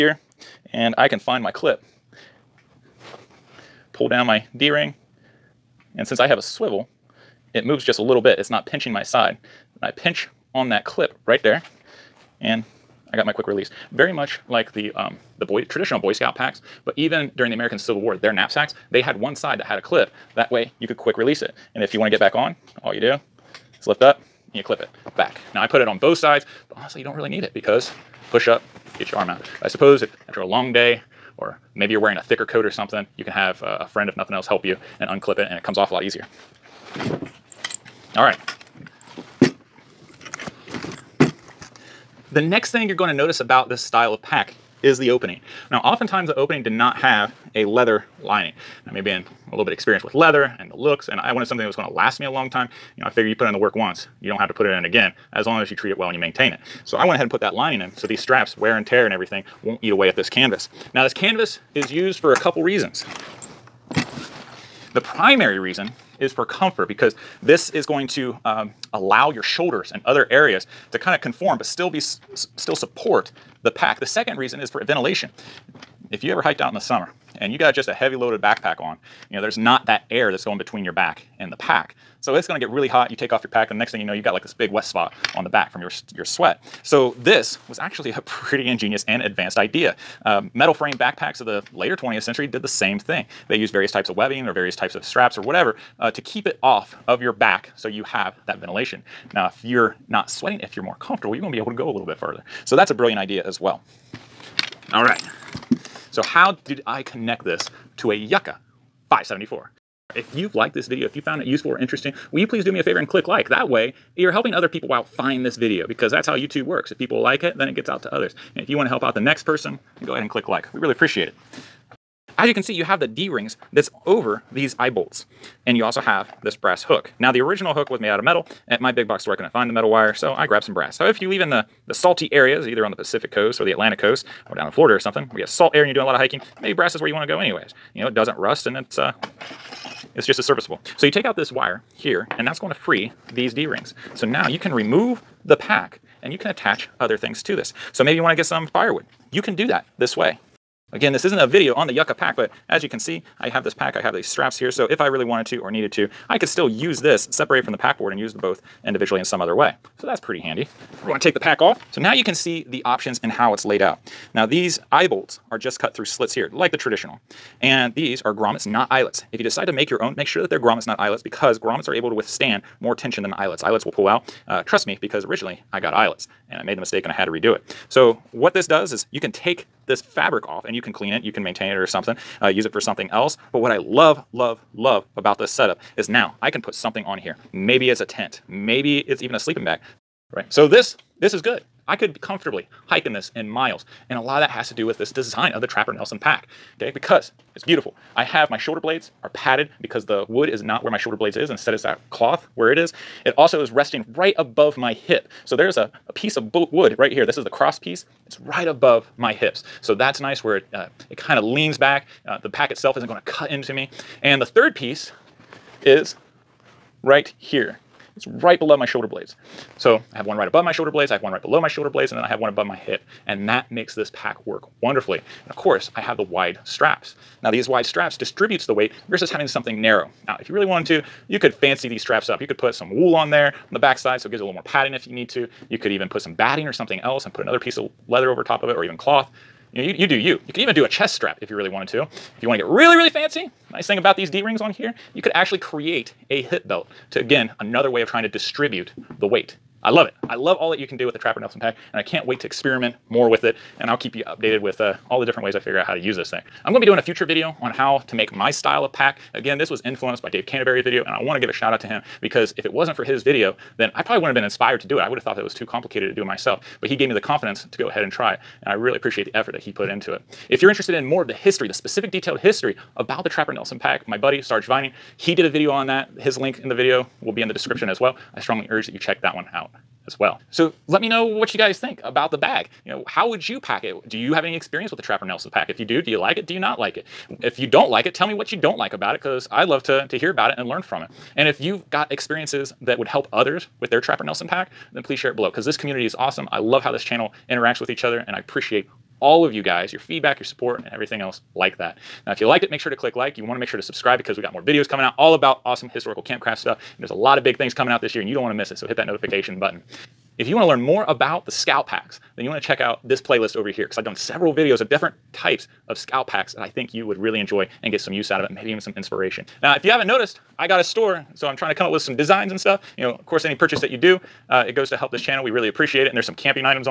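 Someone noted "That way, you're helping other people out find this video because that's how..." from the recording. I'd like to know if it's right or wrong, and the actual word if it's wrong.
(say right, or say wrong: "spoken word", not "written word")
right.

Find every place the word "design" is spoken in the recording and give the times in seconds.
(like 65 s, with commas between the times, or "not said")
195 s, 322 s.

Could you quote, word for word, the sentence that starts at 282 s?
You know, how would you pack it?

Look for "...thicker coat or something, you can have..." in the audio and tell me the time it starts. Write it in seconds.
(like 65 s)
32 s.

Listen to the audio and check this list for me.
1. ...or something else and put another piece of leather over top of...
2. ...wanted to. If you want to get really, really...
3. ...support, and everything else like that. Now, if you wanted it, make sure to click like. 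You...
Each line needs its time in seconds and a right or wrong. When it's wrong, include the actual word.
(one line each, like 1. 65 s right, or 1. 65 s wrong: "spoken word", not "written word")
1. 236 s right
2. 241 s right
3. 300 s wrong: "liked", not "wanted".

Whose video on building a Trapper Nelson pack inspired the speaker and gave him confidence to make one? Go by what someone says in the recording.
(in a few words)
Dave Canterbury.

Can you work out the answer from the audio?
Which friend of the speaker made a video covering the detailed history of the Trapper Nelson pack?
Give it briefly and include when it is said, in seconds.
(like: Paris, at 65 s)
Sarge Vining, at 274 s.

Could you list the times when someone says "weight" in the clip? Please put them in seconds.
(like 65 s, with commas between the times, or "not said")
228 s, 249 s.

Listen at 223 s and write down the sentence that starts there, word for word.
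And that makes this pack work wonderfully.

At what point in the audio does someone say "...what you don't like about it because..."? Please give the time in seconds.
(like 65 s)
288 s.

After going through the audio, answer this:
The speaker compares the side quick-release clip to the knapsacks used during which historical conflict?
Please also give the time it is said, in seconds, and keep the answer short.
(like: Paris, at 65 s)
American Civil War, at 17 s.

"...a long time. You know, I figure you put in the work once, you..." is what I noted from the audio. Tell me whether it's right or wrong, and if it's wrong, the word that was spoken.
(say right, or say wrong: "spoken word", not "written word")
right.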